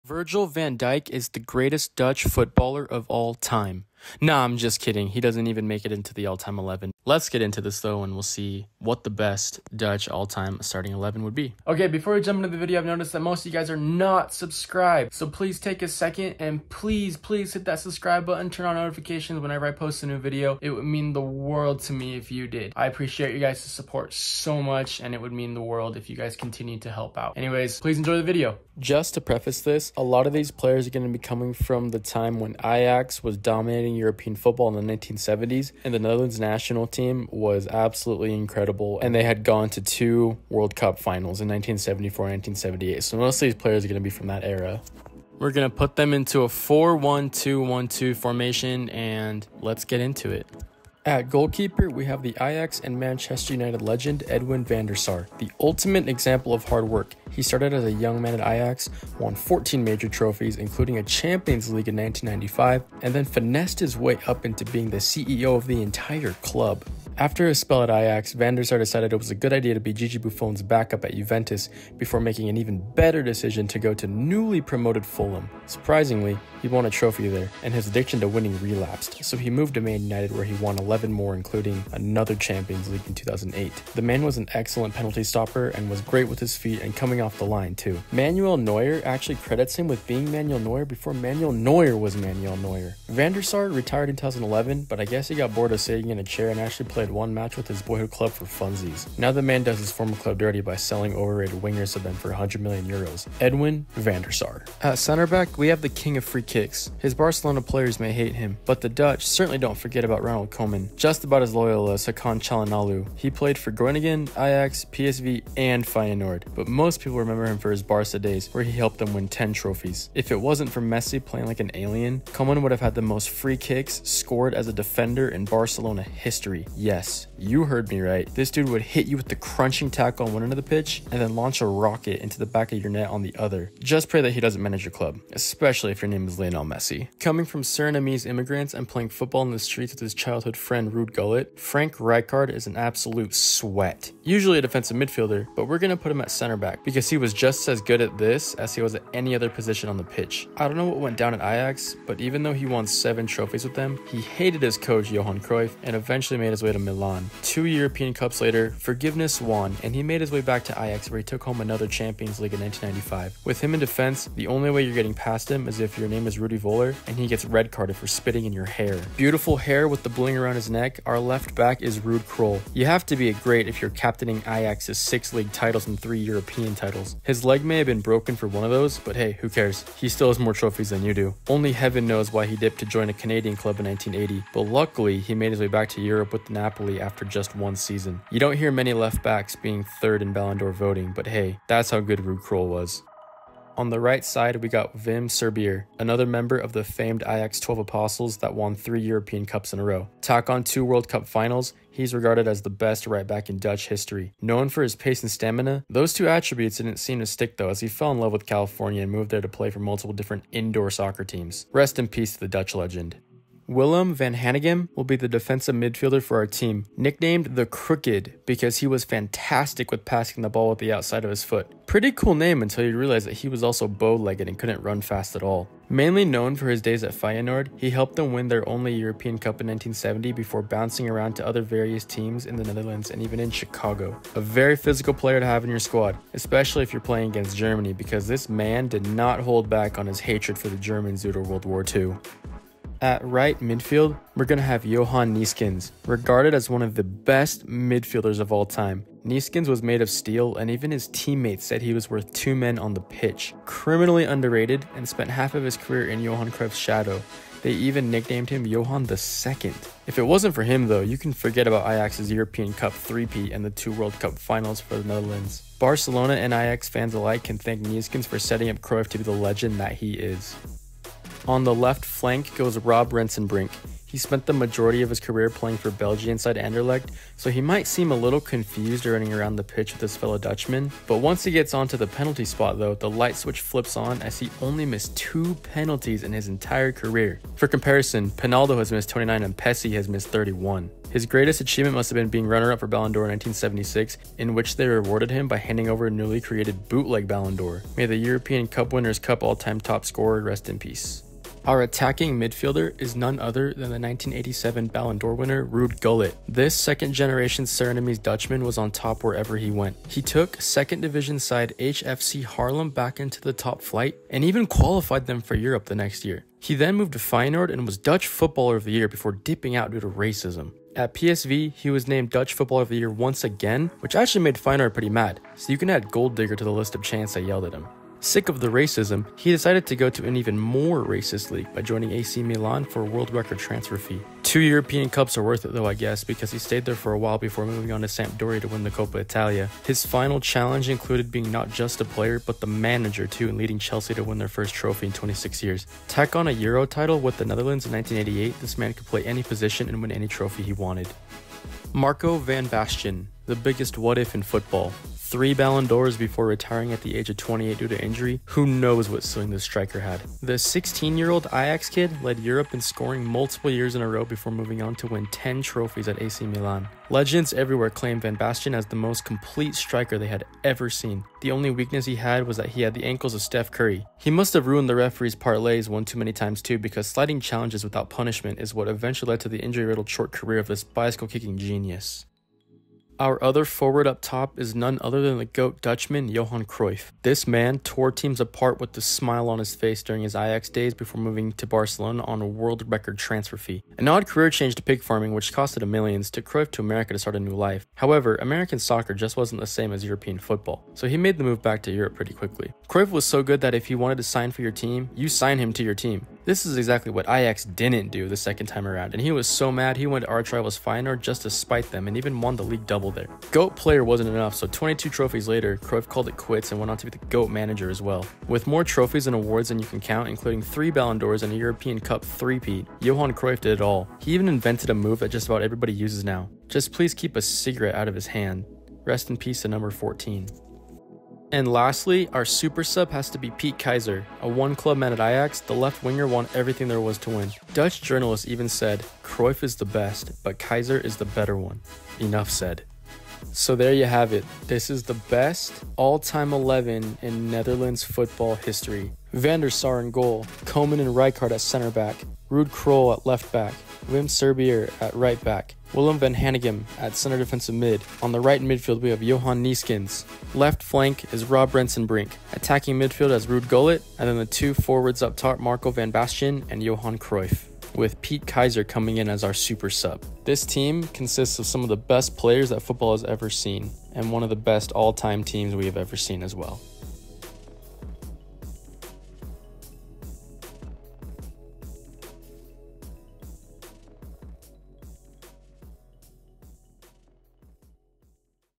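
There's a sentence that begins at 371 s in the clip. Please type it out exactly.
The only weakness he had was that he had the ankles of Steph Curry.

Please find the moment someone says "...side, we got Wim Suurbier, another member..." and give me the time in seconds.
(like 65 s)
194 s.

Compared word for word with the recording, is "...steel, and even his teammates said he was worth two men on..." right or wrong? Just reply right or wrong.
right.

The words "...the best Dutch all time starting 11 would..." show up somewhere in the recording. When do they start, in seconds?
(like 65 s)
9 s.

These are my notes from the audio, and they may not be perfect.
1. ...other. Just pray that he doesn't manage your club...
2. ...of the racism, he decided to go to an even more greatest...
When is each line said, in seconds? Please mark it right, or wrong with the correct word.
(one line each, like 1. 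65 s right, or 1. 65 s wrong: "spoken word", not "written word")
1. 133 s right
2. 328 s wrong: "racist", not "greatest".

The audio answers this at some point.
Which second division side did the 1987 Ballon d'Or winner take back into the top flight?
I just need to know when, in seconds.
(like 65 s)
311 s.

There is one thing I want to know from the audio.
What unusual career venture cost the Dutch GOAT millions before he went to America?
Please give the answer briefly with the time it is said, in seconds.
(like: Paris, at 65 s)
pig farming, at 394 s.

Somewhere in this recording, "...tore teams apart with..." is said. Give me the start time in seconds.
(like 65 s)
387 s.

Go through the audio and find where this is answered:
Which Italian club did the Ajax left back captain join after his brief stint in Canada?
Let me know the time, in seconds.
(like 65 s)
186 s.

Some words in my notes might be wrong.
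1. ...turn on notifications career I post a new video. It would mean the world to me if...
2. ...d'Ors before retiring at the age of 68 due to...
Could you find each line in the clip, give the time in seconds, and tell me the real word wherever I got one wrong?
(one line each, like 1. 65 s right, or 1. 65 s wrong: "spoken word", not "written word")
1. 18 s wrong: "whenever", not "career"
2. 355 s wrong: "28", not "68".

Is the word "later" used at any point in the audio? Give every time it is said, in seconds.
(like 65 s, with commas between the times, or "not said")
158 s, 415 s.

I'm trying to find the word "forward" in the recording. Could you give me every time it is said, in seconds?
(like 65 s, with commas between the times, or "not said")
383 s, 464 s.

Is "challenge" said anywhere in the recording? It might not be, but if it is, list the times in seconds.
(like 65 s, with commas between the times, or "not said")
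340 s, 377 s.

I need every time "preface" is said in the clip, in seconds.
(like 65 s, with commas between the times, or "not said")
29 s.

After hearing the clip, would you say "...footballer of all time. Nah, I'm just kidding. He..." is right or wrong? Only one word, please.
right.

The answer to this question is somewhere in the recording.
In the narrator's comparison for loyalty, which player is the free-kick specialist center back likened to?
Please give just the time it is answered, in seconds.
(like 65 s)
112 s.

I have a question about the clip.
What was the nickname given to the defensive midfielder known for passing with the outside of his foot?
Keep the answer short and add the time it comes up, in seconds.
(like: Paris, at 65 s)
the Crooked, at 217 s.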